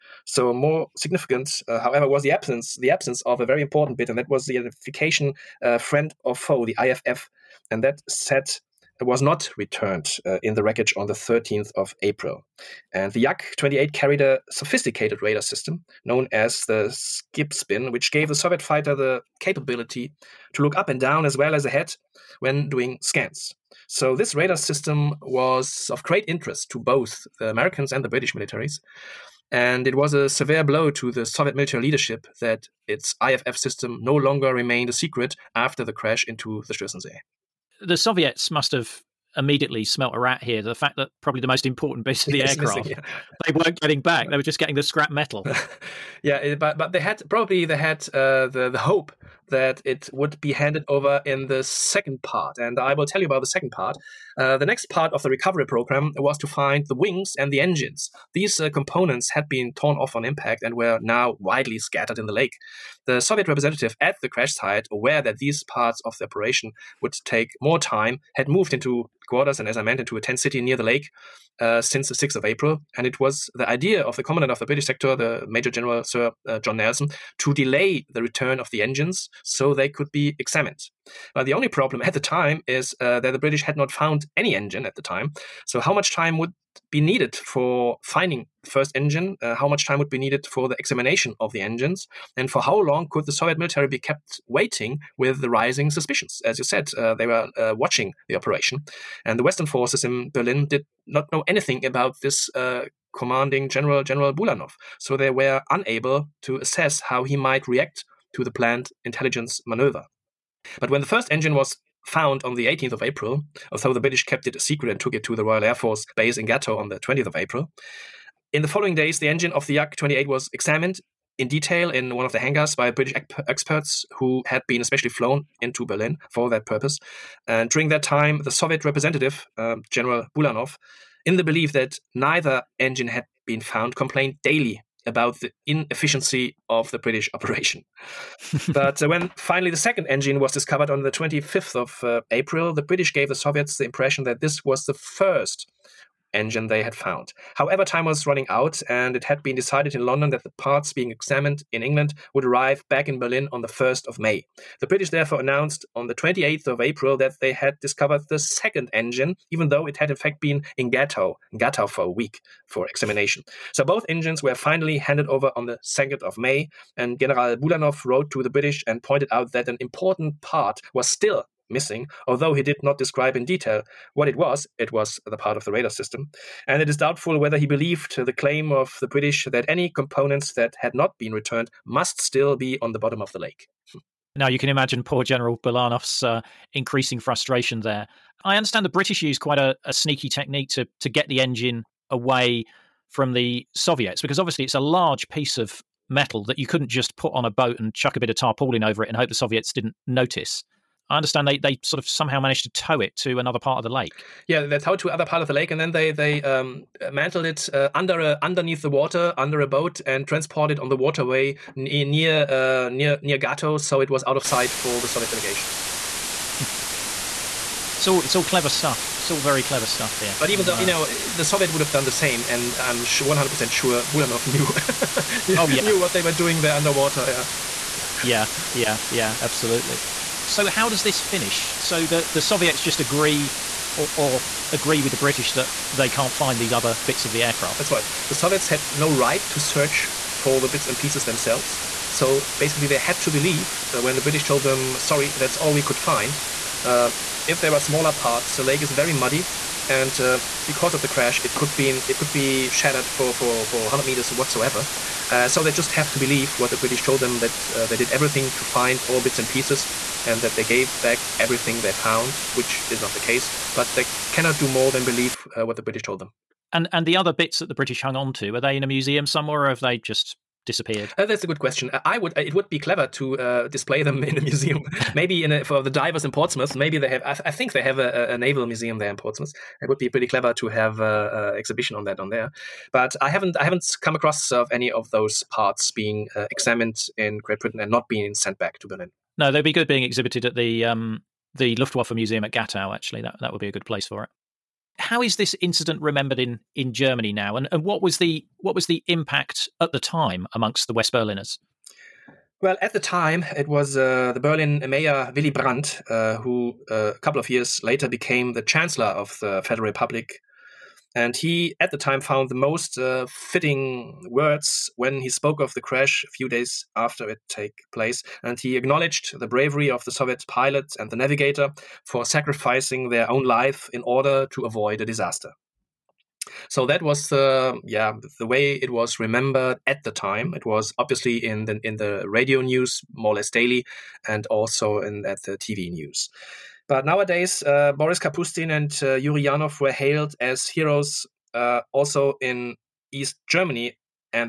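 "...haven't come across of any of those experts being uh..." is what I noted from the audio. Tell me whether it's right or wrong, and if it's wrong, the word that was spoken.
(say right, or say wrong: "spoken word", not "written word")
wrong: "parts", not "experts".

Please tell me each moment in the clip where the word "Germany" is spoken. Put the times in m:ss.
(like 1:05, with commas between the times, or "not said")
4:56, 5:43.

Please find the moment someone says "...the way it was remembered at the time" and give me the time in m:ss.
5:28.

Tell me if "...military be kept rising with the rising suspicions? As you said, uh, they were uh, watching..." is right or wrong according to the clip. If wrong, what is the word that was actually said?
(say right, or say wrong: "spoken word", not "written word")
wrong: "waiting", not "rising".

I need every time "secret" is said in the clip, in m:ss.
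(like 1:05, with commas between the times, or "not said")
0:34, 1:54.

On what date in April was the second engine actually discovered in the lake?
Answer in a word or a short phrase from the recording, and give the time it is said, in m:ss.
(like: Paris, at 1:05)
25th of April, at 2:21.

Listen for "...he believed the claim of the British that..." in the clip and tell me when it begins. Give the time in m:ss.
2:57.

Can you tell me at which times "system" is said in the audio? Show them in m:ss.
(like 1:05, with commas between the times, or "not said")
0:15, 0:24, 0:33, 2:55.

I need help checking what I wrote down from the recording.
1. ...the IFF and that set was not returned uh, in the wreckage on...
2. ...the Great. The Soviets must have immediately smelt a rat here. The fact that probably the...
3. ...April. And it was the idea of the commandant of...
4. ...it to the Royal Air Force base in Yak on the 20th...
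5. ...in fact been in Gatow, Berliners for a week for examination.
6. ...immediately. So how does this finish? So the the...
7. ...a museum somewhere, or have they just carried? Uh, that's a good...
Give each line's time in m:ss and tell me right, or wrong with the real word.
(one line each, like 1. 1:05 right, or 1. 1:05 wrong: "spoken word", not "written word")
1. 0:06 right
2. 0:36 wrong: "Stößensee", not "Great"
3. 1:12 right
4. 1:55 wrong: "Gatow", not "Yak"
5. 2:40 wrong: "Gatow", not "Berliners"
6. 3:49 wrong: "absolutely", not "immediately"
7. 4:28 wrong: "disappeared", not "carried".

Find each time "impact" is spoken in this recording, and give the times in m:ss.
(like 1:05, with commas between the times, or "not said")
1:00, 4:59.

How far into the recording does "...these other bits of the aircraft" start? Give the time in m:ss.
3:56.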